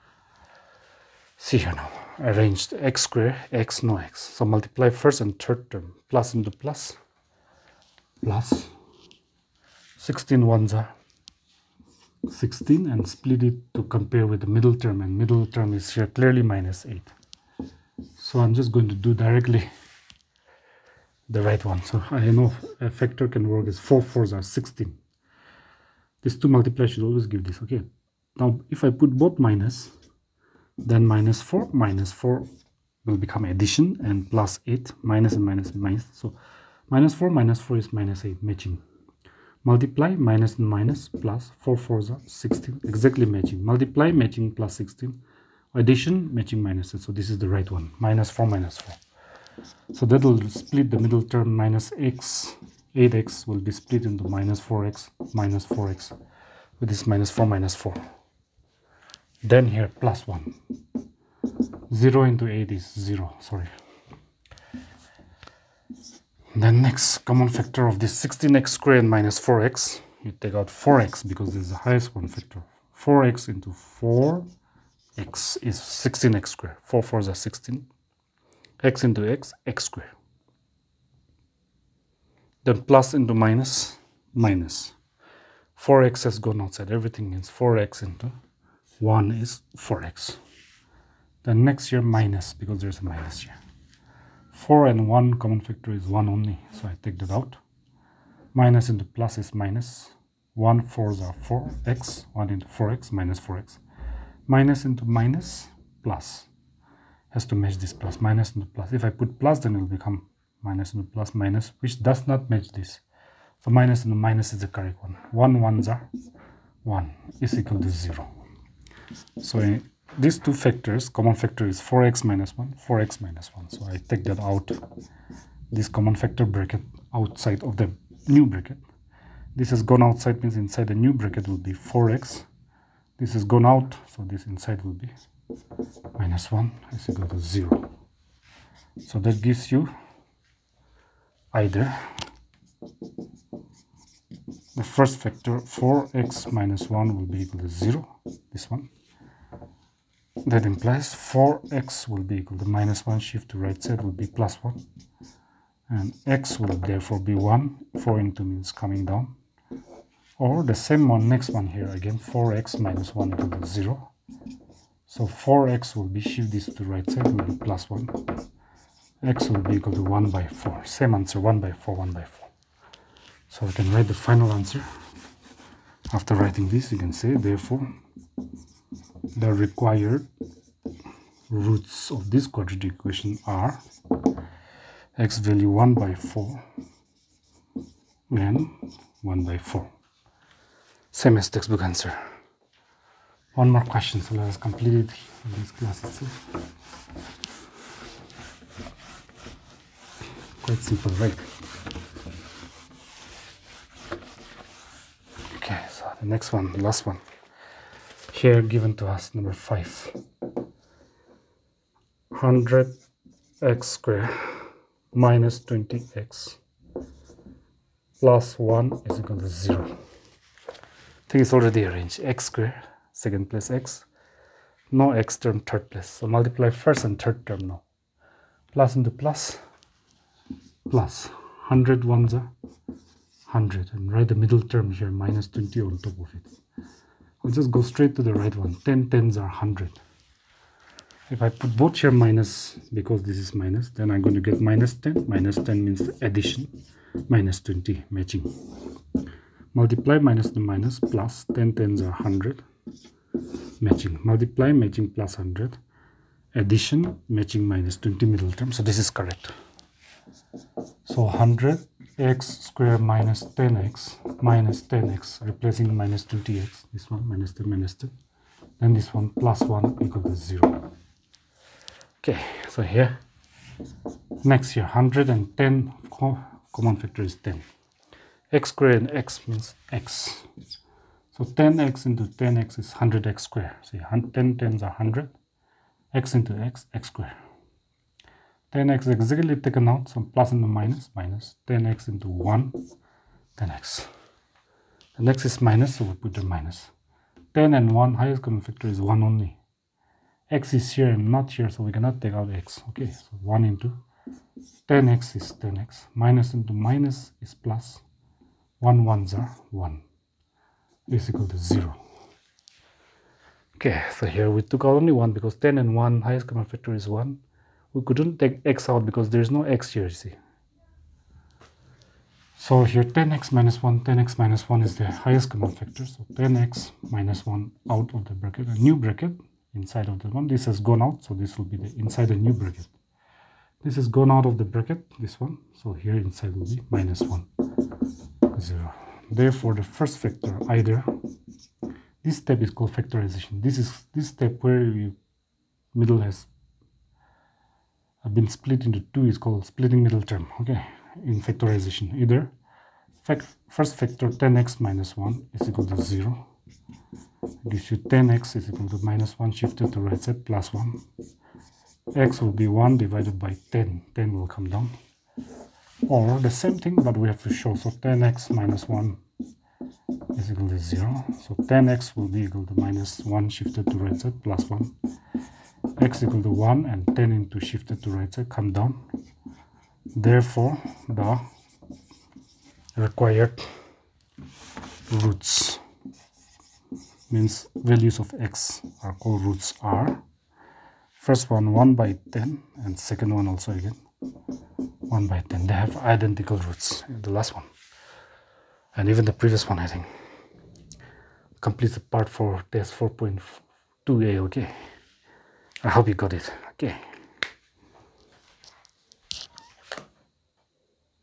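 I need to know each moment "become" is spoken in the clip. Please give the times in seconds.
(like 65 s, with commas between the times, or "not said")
33 s, 109 s.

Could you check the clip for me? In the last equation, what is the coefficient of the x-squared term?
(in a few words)
100.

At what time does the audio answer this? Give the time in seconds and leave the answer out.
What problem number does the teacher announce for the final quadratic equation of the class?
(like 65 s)
209 s.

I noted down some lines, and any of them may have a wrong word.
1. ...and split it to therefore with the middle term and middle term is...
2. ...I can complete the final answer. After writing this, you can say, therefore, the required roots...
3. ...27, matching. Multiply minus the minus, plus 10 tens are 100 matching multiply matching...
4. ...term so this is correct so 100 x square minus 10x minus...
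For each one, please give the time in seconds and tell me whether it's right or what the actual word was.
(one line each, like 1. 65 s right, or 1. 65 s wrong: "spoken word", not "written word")
1. 12 s wrong: "compare", not "therefore"
2. 173 s wrong: "write", not "complete"
3. 247 s wrong: "20", not "27"
4. 258 s right.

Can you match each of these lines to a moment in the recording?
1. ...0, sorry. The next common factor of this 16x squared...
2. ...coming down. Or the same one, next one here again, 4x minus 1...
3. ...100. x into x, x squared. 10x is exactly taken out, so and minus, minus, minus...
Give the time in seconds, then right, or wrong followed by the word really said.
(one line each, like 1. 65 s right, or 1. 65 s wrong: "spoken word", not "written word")
1. 62 s right
2. 158 s right
3. 284 s right.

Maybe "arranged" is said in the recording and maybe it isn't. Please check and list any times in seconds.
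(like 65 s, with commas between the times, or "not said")
2 s, 221 s.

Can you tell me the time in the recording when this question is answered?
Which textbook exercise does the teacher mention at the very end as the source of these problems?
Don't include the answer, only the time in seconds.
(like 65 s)
402 s.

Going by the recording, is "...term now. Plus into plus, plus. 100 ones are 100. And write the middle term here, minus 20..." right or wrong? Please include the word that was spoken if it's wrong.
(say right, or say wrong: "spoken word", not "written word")
right.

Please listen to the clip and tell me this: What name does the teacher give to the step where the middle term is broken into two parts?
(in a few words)
splitting middle term.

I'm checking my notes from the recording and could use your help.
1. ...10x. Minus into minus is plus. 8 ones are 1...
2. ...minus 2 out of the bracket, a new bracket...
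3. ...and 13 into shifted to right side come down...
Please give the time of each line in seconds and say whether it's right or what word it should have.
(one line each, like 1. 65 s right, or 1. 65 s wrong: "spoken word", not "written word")
1. 305 s wrong: "1", not "8"
2. 327 s wrong: "1", not "2"
3. 376 s wrong: "10", not "13".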